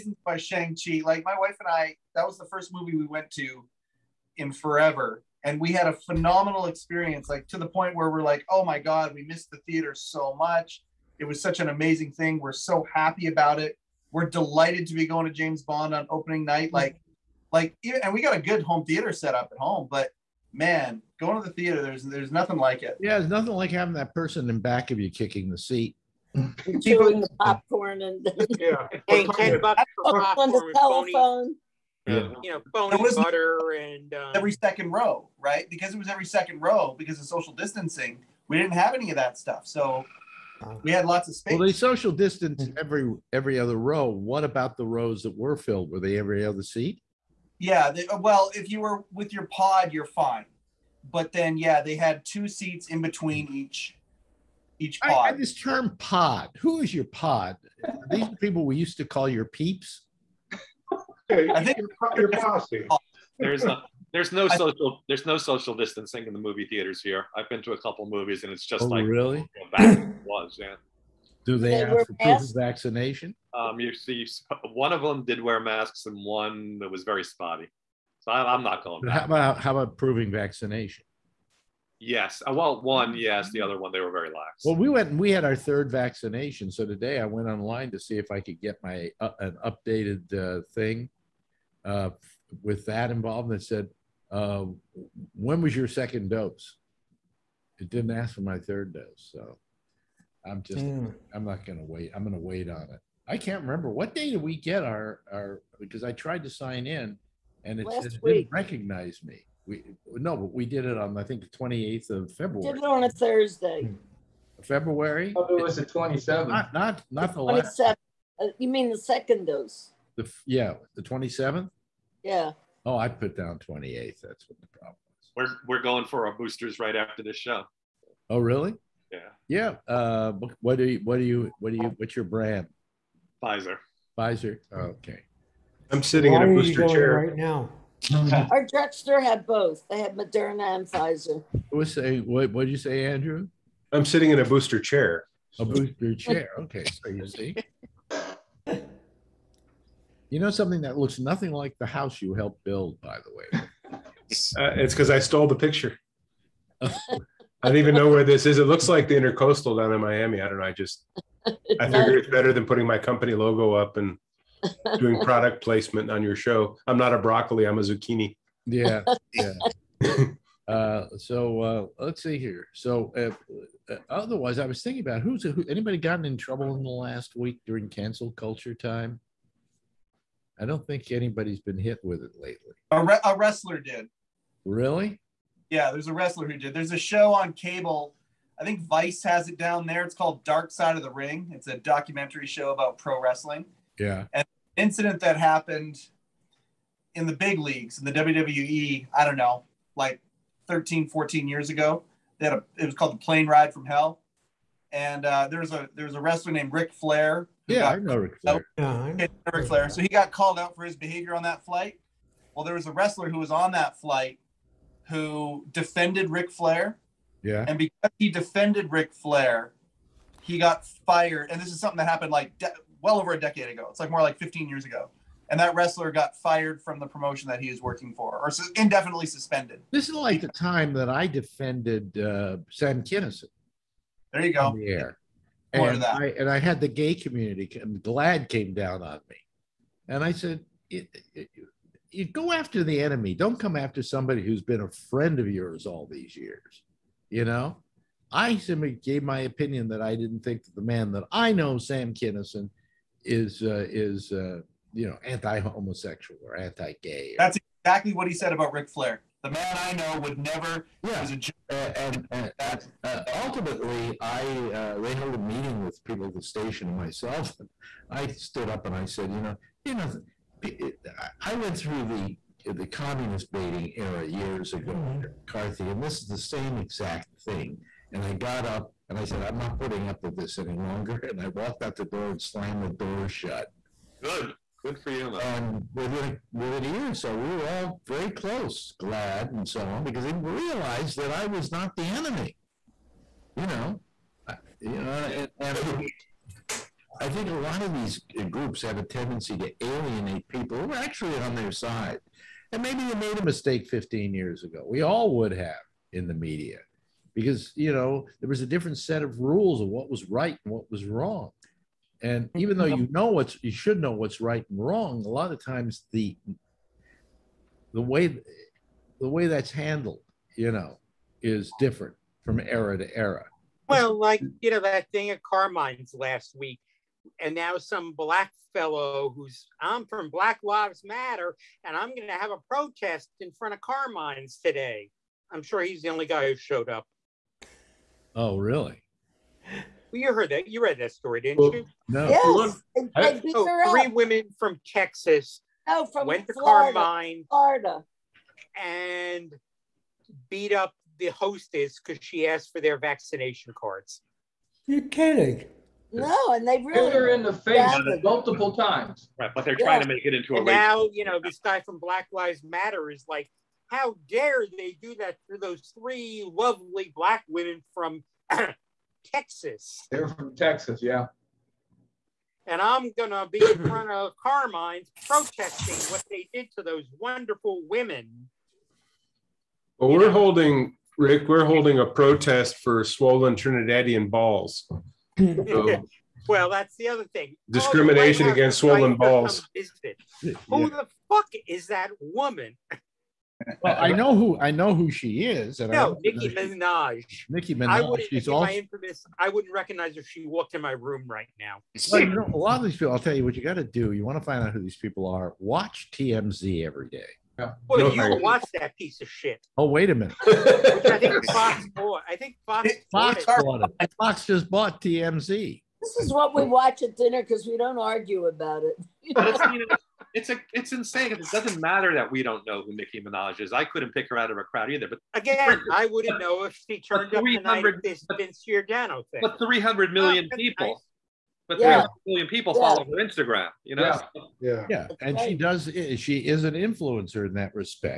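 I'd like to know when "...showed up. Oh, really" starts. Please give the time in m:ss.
5:36.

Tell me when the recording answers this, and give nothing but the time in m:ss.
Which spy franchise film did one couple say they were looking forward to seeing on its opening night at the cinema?
0:15.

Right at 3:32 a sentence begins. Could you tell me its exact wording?
Well, there was a wrestler who was on that flight who defended Ric Flair.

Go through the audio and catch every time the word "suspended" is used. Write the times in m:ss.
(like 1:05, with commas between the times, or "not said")
3:49.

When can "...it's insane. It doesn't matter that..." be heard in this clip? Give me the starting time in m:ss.
7:00.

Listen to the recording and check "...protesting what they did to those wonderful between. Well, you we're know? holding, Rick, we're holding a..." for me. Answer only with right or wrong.
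wrong.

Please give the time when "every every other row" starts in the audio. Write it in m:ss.
0:42.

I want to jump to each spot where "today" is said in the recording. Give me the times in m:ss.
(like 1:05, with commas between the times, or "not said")
1:26, 5:34.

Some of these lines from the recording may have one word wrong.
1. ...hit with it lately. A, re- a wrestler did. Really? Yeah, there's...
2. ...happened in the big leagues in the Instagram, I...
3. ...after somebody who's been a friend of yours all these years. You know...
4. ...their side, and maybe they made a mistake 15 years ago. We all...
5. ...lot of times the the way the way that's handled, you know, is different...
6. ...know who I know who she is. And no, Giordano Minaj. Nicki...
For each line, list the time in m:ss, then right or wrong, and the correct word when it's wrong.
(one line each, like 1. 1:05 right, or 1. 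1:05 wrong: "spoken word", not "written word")
1. 3:01 right
2. 3:15 wrong: "WWE", not "Instagram"
3. 4:03 right
4. 5:01 right
5. 5:15 right
6. 6:34 wrong: "Nicki", not "Giordano".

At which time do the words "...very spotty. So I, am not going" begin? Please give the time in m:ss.
1:17.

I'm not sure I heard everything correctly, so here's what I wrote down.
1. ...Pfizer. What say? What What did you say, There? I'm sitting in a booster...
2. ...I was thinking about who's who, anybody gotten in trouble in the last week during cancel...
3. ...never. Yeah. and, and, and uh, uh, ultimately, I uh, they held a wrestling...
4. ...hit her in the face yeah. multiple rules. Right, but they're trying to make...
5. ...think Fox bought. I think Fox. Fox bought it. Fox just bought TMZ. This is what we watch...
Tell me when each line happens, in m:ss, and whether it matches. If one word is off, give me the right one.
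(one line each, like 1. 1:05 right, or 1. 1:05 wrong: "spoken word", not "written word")
1. 2:20 wrong: "Andrew", not "There"
2. 2:54 right
3. 4:20 wrong: "meeting", not "wrestling"
4. 5:57 wrong: "times", not "rules"
5. 6:51 right.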